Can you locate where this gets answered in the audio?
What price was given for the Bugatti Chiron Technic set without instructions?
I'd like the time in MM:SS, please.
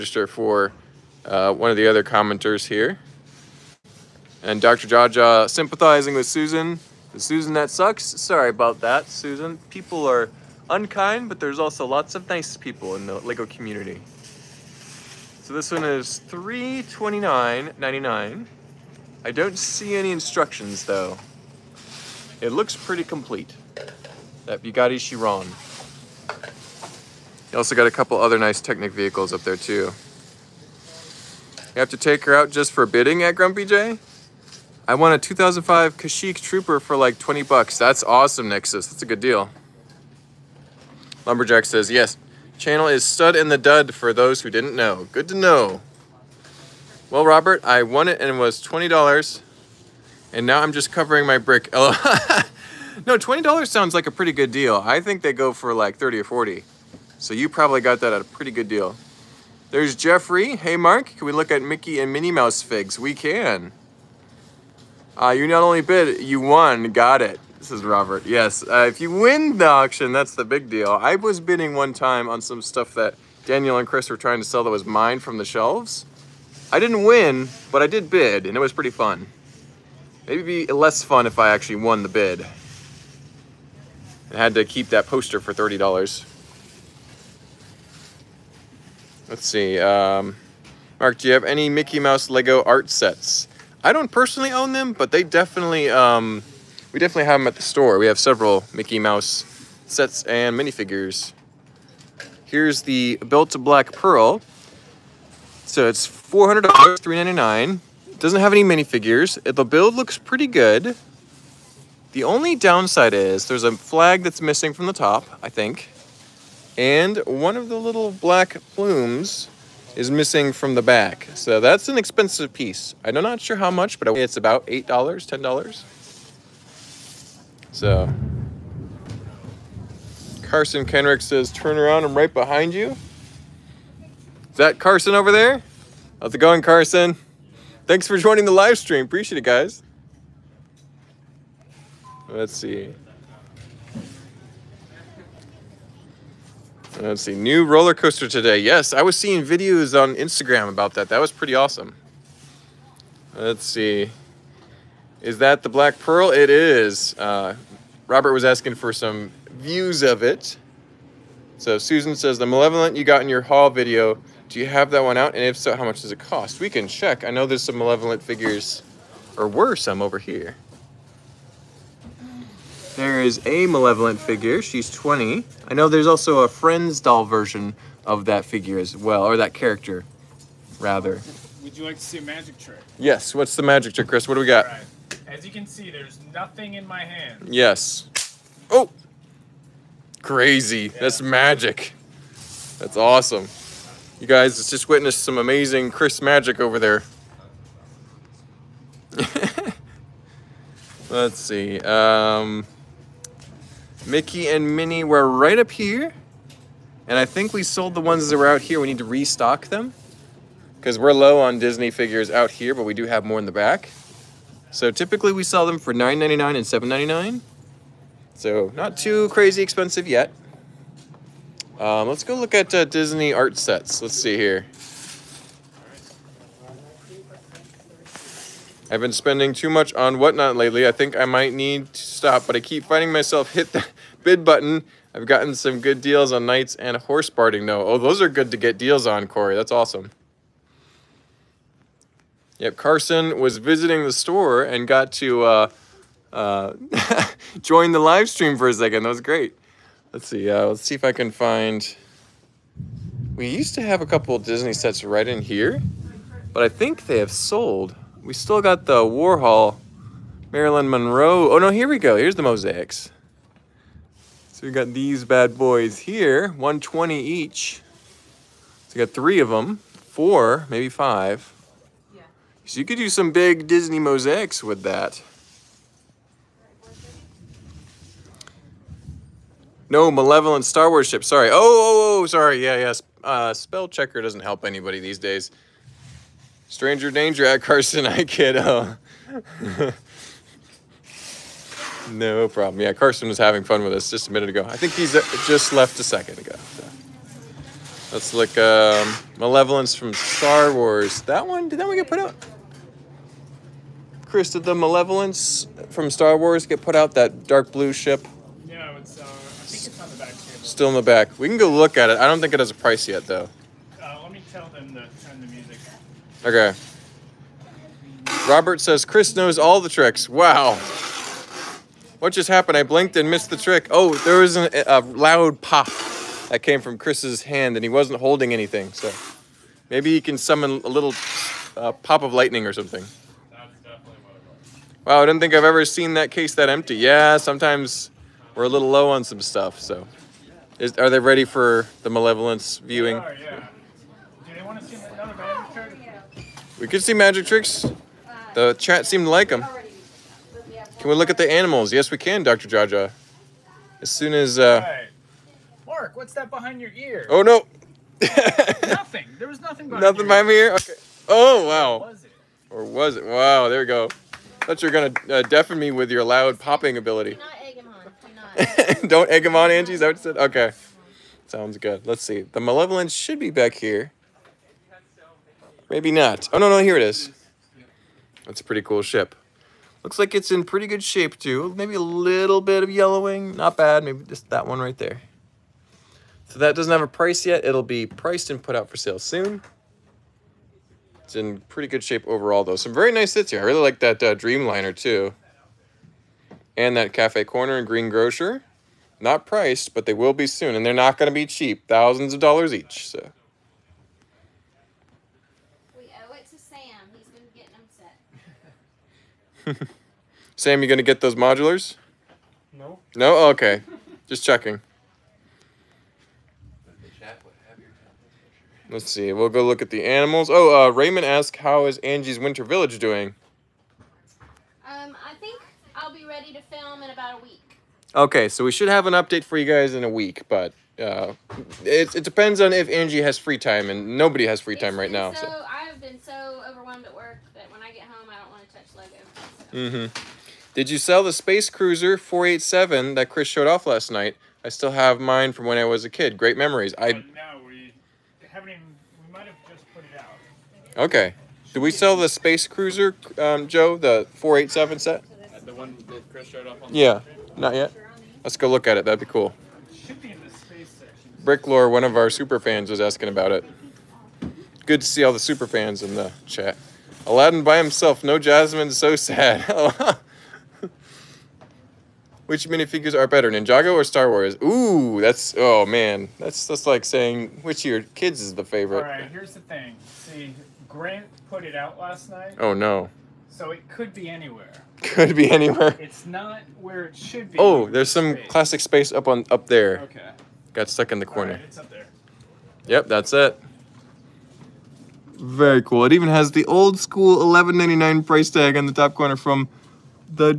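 00:16.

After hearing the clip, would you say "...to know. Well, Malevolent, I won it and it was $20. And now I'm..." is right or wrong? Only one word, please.
wrong.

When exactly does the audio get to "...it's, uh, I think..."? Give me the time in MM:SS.
05:08.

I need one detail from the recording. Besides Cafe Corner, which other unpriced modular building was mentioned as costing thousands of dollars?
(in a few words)
Green Grocer.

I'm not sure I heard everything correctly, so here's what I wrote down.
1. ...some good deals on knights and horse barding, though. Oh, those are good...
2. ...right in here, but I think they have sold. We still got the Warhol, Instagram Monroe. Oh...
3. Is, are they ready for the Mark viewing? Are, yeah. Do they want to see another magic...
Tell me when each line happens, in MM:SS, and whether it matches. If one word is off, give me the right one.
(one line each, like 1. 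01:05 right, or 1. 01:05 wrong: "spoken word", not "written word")
1. 03:55 right
2. 04:15 wrong: "Marilyn", not "Instagram"
3. 05:40 wrong: "Malevolence", not "Mark".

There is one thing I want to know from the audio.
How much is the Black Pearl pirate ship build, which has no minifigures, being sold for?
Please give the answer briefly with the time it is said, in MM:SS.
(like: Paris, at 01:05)
$399, at 01:46.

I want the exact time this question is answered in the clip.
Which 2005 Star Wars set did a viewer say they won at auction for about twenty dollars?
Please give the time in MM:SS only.
00:35.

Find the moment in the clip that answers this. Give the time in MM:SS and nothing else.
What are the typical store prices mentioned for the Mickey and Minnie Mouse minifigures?
03:35.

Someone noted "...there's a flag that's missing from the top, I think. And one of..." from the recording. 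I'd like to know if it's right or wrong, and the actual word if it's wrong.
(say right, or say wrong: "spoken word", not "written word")
right.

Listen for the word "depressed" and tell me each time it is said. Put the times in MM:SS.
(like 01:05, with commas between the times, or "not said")
not said.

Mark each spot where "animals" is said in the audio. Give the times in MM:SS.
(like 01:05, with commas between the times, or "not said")
05:51, 07:00.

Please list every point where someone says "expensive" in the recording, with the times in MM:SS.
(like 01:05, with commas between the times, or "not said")
02:01, 03:39.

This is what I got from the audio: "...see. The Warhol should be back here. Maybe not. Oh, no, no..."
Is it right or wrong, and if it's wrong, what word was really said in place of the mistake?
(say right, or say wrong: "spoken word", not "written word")
wrong: "Malevolence", not "Warhol".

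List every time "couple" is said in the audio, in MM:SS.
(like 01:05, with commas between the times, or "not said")
00:27, 04:14.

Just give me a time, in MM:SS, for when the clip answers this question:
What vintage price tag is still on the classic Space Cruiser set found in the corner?
08:17.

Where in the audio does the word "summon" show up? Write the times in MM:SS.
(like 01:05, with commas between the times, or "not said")
05:30.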